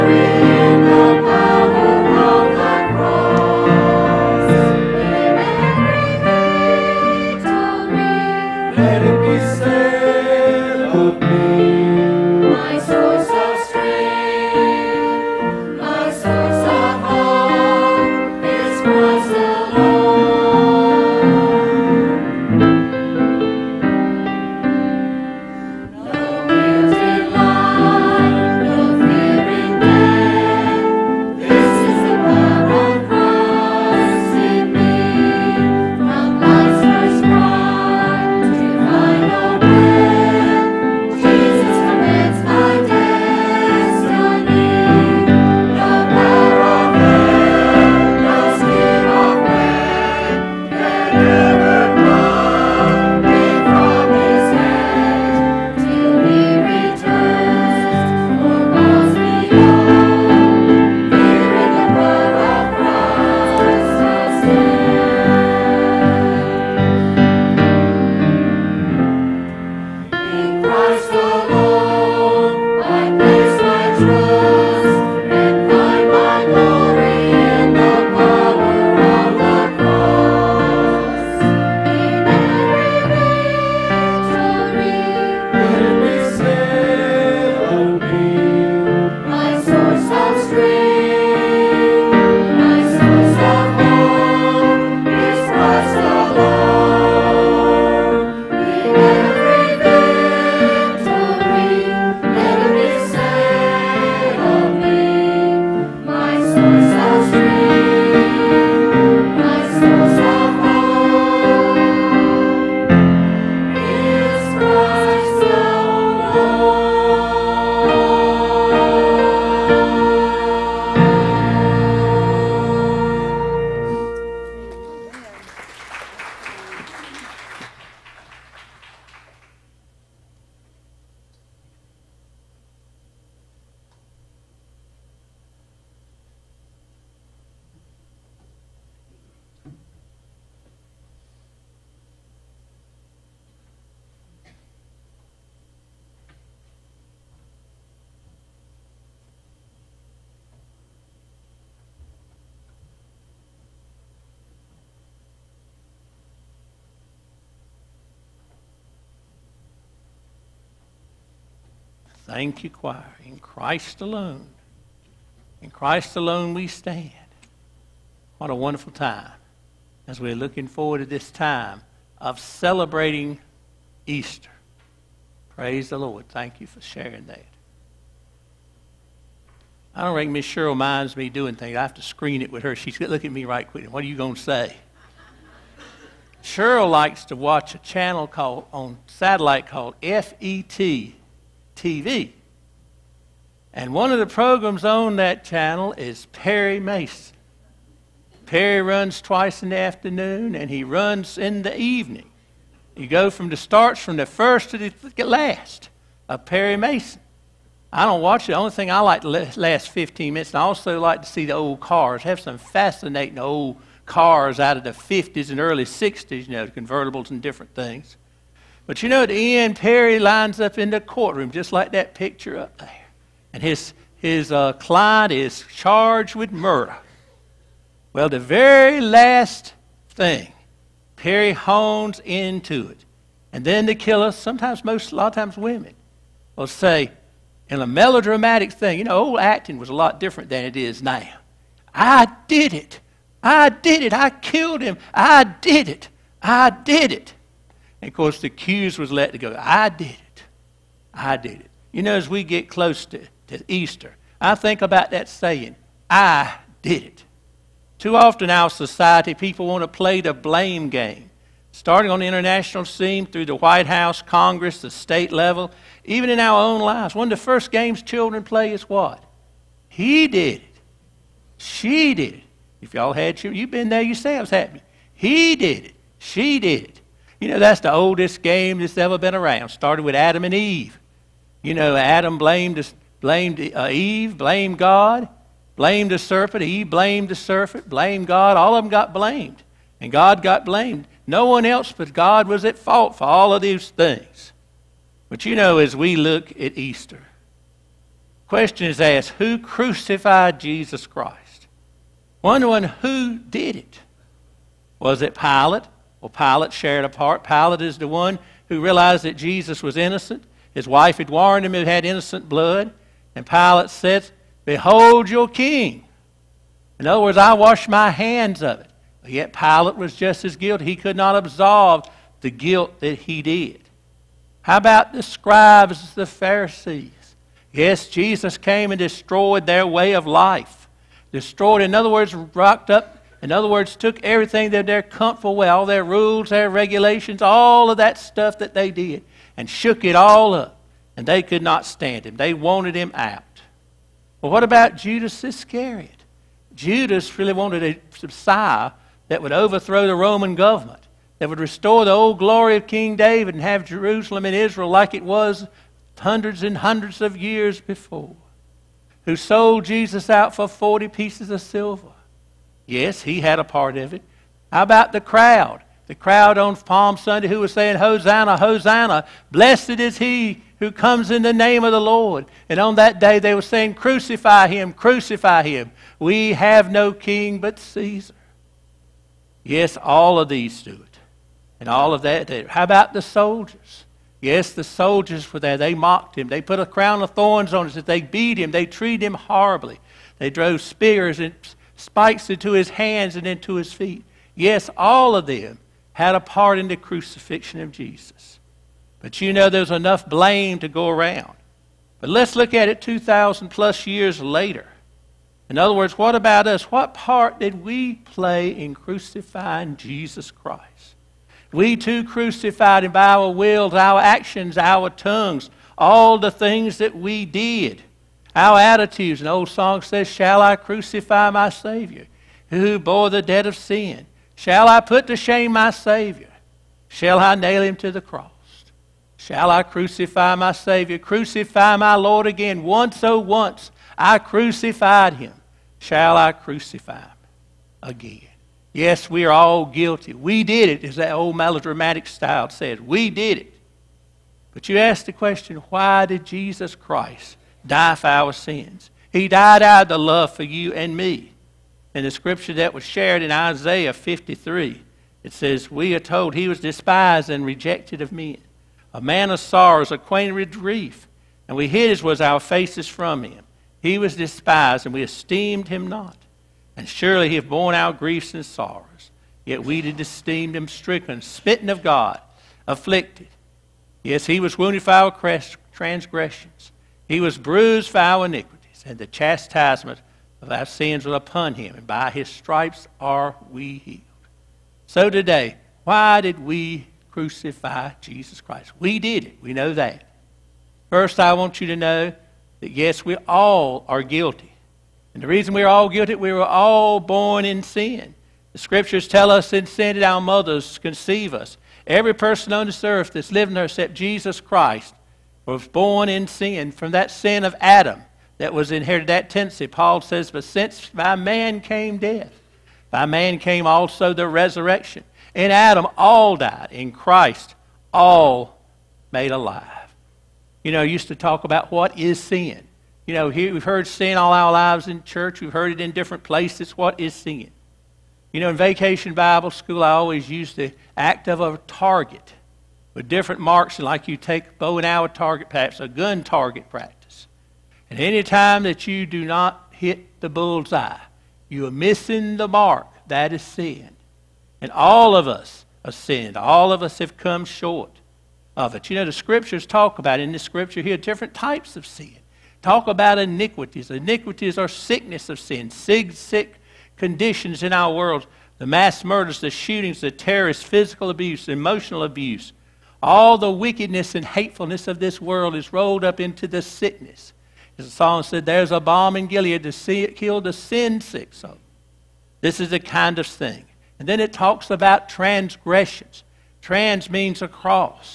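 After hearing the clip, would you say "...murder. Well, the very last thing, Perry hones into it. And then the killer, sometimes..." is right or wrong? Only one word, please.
right.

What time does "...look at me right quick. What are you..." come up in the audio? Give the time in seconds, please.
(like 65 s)
183 s.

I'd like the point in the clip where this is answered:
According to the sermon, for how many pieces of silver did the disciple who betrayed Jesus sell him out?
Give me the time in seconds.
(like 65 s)
360 s.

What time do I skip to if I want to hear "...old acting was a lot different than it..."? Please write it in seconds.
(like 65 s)
239 s.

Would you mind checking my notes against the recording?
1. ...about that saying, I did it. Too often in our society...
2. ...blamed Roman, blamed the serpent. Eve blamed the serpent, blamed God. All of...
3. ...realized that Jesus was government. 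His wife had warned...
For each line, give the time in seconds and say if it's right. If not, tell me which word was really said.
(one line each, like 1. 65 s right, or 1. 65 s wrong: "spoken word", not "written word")
1. 254 s right
2. 284 s wrong: "God", not "Roman"
3. 308 s wrong: "innocent", not "government".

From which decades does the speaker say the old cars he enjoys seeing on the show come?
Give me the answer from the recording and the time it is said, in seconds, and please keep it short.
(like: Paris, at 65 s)
50s and early 60s, at 214 s.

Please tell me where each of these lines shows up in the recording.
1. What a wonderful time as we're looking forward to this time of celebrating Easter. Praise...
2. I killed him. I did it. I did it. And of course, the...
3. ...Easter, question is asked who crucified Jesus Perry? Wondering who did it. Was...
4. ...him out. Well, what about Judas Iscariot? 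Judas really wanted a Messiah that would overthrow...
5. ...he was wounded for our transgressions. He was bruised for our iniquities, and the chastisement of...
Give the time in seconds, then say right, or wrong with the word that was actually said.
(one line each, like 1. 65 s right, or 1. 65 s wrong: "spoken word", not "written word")
1. 168 s right
2. 244 s right
3. 296 s wrong: "Christ", not "Perry"
4. 342 s right
5. 474 s right.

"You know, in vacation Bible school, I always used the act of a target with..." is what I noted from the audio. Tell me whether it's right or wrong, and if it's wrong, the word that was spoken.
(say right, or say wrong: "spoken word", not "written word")
right.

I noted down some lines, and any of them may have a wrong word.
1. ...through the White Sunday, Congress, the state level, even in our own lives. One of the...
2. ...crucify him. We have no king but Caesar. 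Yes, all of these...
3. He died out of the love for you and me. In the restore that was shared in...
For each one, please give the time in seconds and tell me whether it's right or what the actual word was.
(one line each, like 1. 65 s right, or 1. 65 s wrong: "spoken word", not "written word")
1. 263 s wrong: "House", not "Sunday"
2. 374 s right
3. 449 s wrong: "scripture", not "restore".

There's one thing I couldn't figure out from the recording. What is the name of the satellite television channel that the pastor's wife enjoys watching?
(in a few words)
FET TV.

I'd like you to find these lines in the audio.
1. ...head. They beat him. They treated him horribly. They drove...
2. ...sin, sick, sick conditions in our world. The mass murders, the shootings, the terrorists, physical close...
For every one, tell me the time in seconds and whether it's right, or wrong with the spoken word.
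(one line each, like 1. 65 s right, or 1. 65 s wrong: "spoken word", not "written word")
1. 387 s right
2. 555 s wrong: "abuse", not "close".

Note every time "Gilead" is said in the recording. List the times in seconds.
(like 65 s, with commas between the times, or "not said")
569 s.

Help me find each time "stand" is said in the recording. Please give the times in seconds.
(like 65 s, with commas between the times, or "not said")
166 s, 341 s.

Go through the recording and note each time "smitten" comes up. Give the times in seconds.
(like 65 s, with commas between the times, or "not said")
471 s.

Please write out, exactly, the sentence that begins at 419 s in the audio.
An old song says, Shall I crucify my Savior, who bore the debt of sin?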